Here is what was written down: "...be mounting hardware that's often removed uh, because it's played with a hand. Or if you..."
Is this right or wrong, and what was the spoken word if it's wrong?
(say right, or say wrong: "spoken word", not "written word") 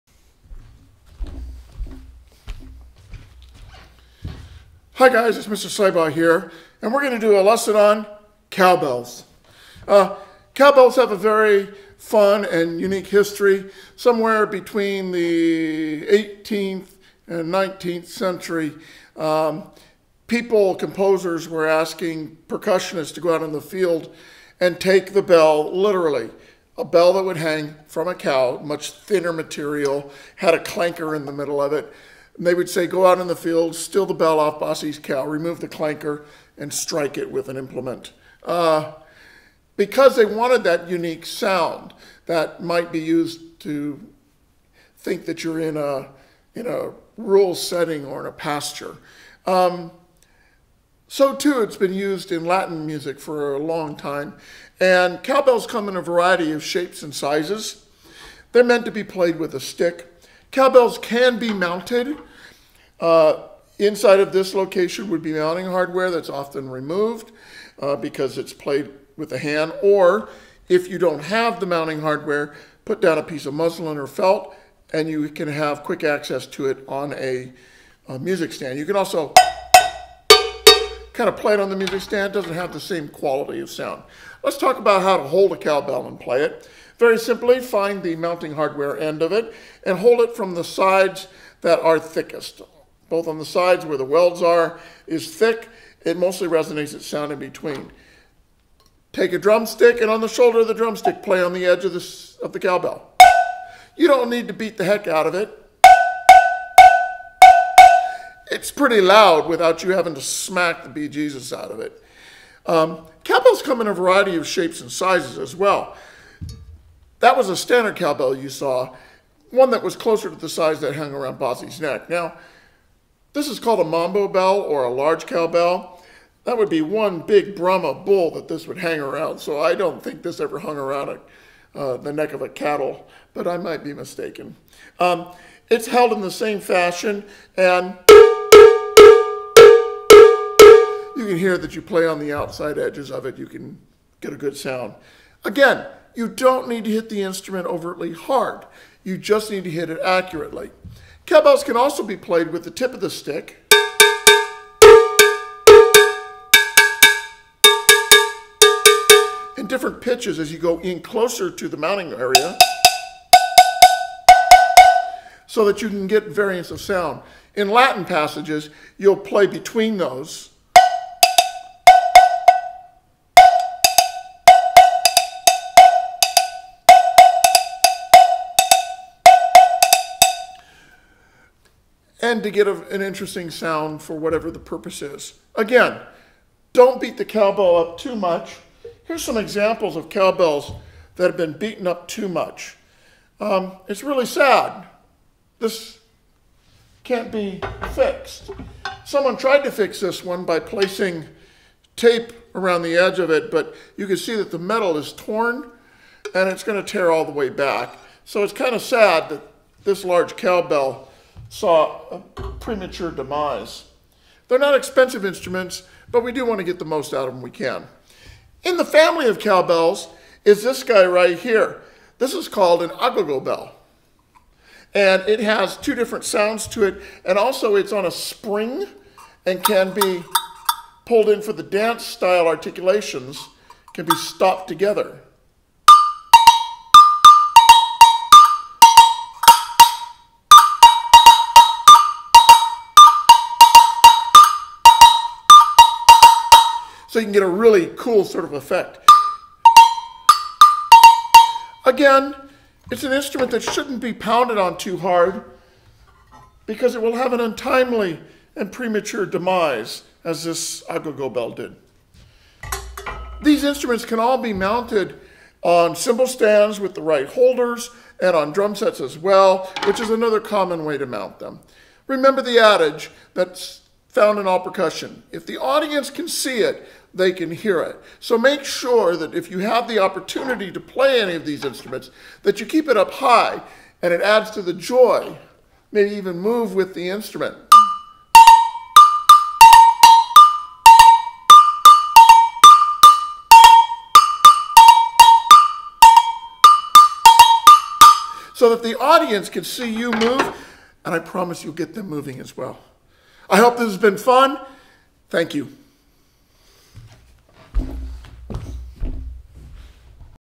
right.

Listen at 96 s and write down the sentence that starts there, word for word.
It mostly resonates its sound in between.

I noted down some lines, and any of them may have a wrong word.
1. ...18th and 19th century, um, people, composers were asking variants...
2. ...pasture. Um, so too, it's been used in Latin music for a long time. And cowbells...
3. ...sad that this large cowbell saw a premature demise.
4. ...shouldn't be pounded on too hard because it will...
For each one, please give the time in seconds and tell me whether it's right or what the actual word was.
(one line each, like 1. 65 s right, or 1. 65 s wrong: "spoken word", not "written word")
1. 16 s wrong: "percussionists", not "variants"
2. 48 s right
3. 208 s right
4. 253 s right.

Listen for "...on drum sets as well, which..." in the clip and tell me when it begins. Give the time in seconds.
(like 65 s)
268 s.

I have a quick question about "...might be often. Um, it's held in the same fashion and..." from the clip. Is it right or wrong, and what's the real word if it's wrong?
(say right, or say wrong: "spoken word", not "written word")
wrong: "mistaken", not "often".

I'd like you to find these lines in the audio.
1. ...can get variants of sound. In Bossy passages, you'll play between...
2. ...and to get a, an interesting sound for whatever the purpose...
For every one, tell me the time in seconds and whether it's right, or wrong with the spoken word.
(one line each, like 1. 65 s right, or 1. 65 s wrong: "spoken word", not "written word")
1. 165 s wrong: "Latin", not "Bossy"
2. 182 s right.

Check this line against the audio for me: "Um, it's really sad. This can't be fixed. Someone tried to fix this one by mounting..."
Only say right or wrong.
wrong.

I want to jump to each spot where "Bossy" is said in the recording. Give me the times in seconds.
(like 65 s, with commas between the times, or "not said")
34 s, 121 s.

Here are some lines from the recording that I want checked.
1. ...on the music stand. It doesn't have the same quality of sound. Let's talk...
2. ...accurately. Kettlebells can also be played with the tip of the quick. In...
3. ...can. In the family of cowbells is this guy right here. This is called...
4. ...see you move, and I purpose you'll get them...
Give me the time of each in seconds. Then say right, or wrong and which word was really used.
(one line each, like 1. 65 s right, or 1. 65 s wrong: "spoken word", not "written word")
1. 81 s right
2. 150 s wrong: "stick", not "quick"
3. 217 s right
4. 299 s wrong: "promise", not "purpose".